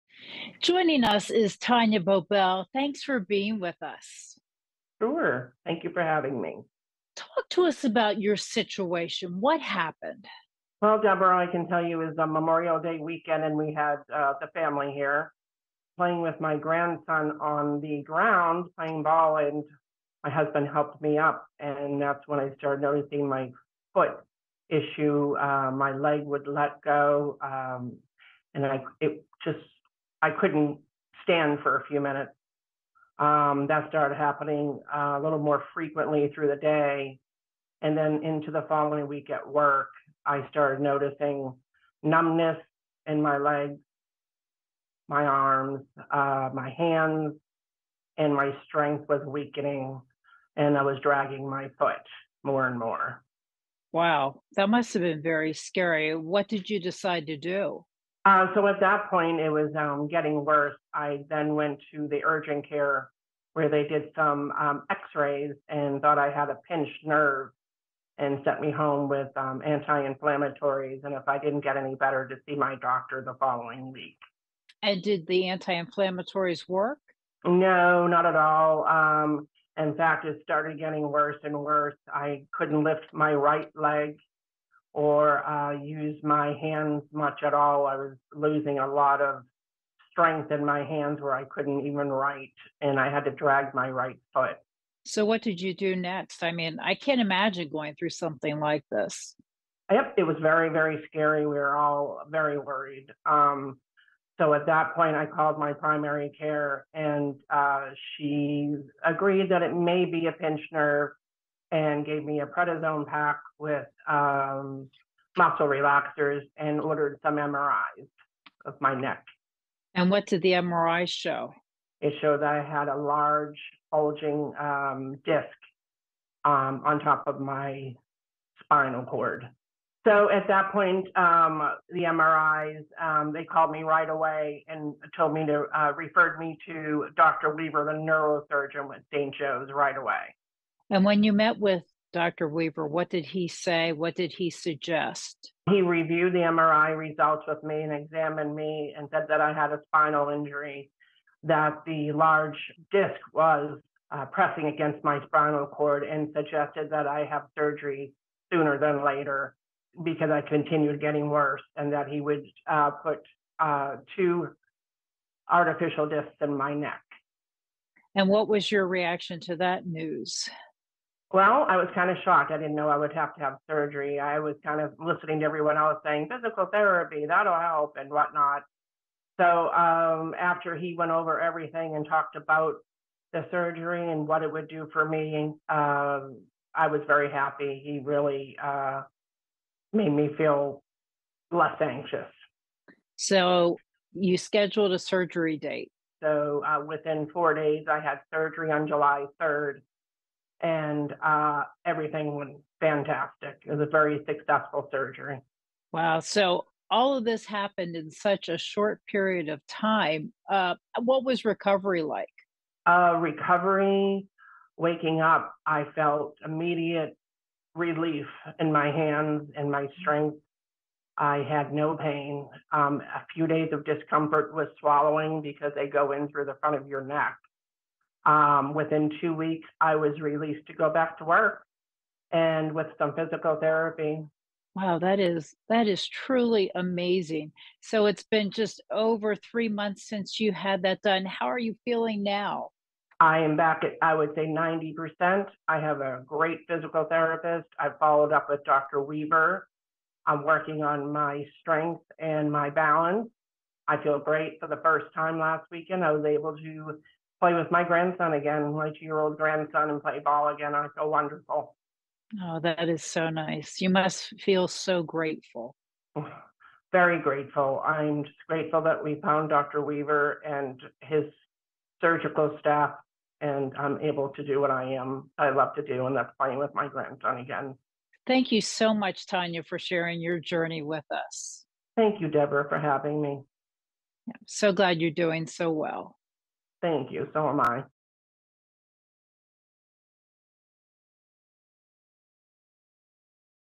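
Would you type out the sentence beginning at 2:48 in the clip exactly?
And what was your reaction to that news?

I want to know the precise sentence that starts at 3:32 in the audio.
Uh, recovery, waking up, I felt immediate relief in my hands and my mm-hmm.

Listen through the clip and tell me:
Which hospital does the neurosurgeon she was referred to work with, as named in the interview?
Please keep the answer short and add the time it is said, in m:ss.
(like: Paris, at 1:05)
St. Joe's, at 2:19.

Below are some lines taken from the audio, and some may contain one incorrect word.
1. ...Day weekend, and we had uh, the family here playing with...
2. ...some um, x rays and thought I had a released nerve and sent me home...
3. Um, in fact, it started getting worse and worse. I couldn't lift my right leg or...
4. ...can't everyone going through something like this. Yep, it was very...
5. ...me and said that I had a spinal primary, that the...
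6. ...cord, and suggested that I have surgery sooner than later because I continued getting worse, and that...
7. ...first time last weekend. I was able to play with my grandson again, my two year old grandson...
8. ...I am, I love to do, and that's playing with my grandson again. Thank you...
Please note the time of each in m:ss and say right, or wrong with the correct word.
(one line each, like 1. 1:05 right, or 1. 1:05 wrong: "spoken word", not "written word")
1. 0:12 right
2. 1:04 wrong: "pinched", not "released"
3. 1:18 right
4. 1:36 wrong: "imagine", not "everyone"
5. 2:28 wrong: "injury", not "primary"
6. 2:35 right
7. 4:14 right
8. 4:34 right.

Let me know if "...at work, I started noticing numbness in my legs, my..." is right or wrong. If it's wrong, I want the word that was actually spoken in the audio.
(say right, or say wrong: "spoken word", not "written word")
right.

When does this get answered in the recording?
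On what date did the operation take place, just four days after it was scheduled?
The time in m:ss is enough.
3:18.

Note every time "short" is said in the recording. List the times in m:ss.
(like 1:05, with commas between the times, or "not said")
3:28.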